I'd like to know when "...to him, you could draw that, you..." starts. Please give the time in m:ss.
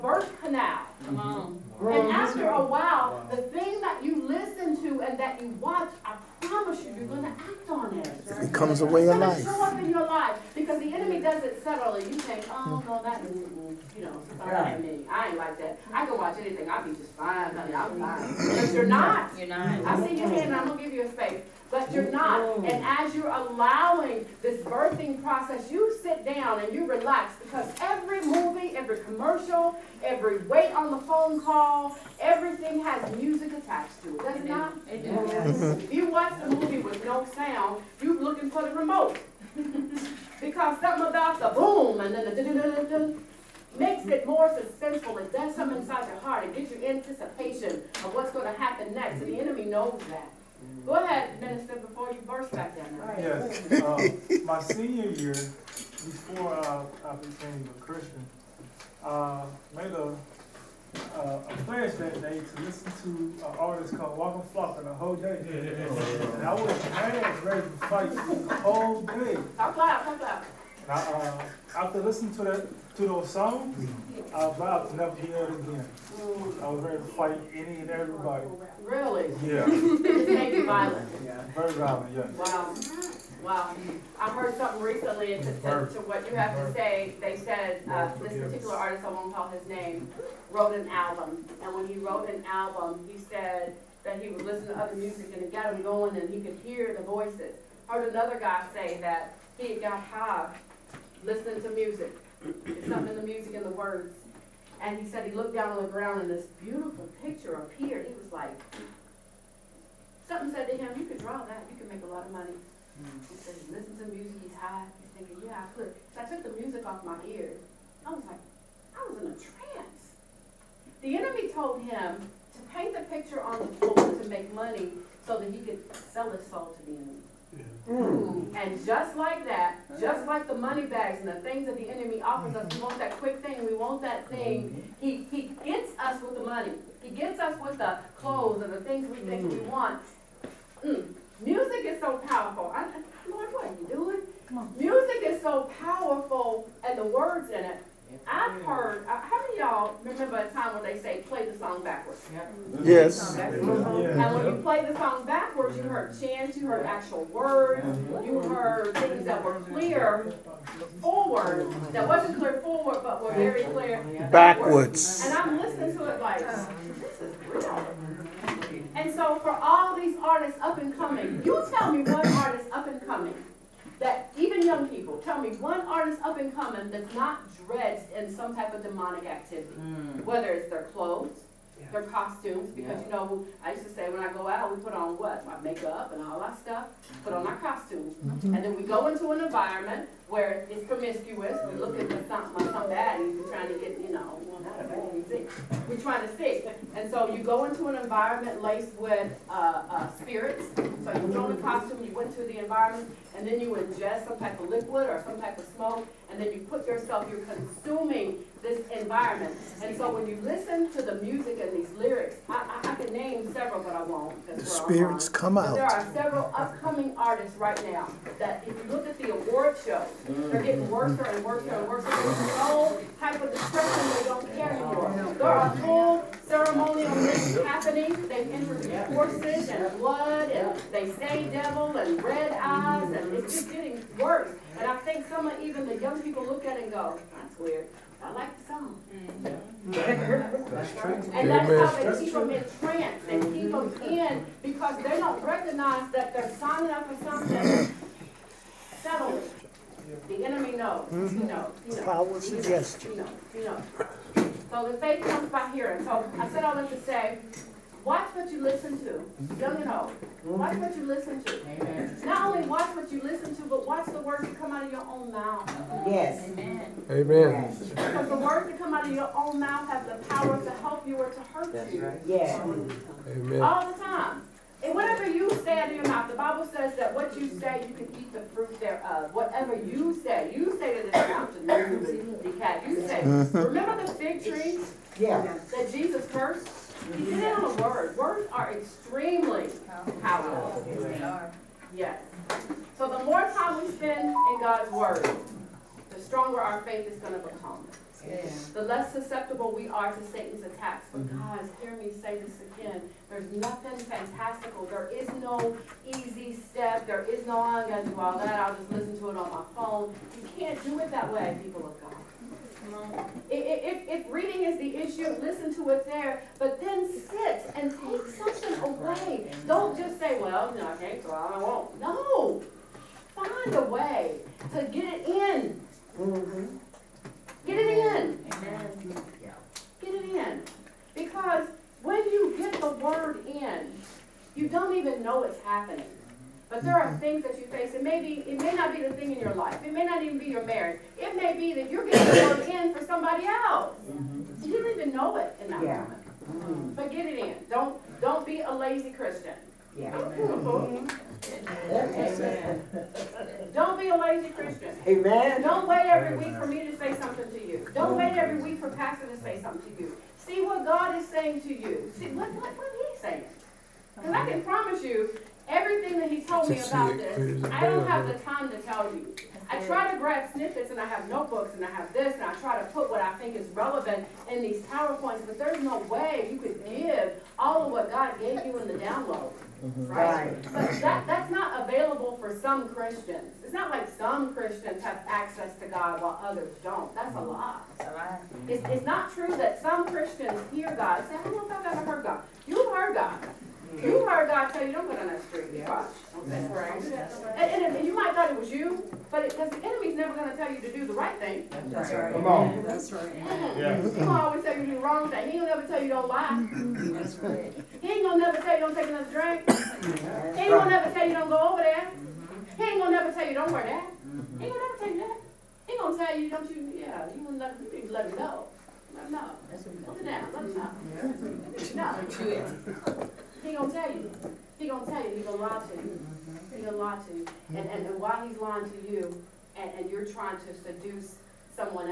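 1:50.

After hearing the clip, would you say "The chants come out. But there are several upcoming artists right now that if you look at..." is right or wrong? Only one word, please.
wrong.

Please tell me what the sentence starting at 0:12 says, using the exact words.
you think, oh, no, that, you know, yeah.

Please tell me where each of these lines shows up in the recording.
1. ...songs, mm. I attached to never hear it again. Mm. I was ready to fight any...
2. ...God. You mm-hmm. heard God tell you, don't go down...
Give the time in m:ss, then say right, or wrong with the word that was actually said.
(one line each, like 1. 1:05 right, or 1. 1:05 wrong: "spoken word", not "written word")
1. 1:13 wrong: "vowed", not "attached"
2. 6:33 right.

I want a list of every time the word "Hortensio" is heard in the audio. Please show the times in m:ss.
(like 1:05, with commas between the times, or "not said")
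not said.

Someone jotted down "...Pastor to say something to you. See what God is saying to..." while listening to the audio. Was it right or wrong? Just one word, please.
right.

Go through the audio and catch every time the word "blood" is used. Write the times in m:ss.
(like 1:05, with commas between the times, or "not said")
3:49.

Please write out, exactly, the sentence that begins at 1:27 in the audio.
They said uh, this particular artist, I won't call his name, wrote an album.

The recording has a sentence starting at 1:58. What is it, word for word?
I was like, I was in a trance.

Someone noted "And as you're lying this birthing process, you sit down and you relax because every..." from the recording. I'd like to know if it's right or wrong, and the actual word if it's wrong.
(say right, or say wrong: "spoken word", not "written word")
wrong: "allowing", not "lying".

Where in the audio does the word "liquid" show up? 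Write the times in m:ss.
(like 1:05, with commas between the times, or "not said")
3:24.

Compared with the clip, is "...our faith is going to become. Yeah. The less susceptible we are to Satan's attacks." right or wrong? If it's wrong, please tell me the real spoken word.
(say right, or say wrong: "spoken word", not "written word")
right.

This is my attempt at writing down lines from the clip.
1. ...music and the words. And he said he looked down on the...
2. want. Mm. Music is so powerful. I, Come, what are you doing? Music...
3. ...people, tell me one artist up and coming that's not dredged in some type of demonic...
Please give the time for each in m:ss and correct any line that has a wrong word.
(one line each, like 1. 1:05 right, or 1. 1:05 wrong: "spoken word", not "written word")
1. 1:43 right
2. 2:19 wrong: "Lord", not "Come"
3. 2:54 right.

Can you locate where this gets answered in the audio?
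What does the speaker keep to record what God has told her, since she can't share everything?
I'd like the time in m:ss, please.
6:11.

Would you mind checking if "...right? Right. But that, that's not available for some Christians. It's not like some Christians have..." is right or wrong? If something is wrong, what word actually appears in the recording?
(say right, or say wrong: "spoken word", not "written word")
right.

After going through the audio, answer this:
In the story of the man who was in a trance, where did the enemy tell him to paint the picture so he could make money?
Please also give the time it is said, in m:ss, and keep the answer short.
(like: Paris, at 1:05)
on the floor, at 2:03.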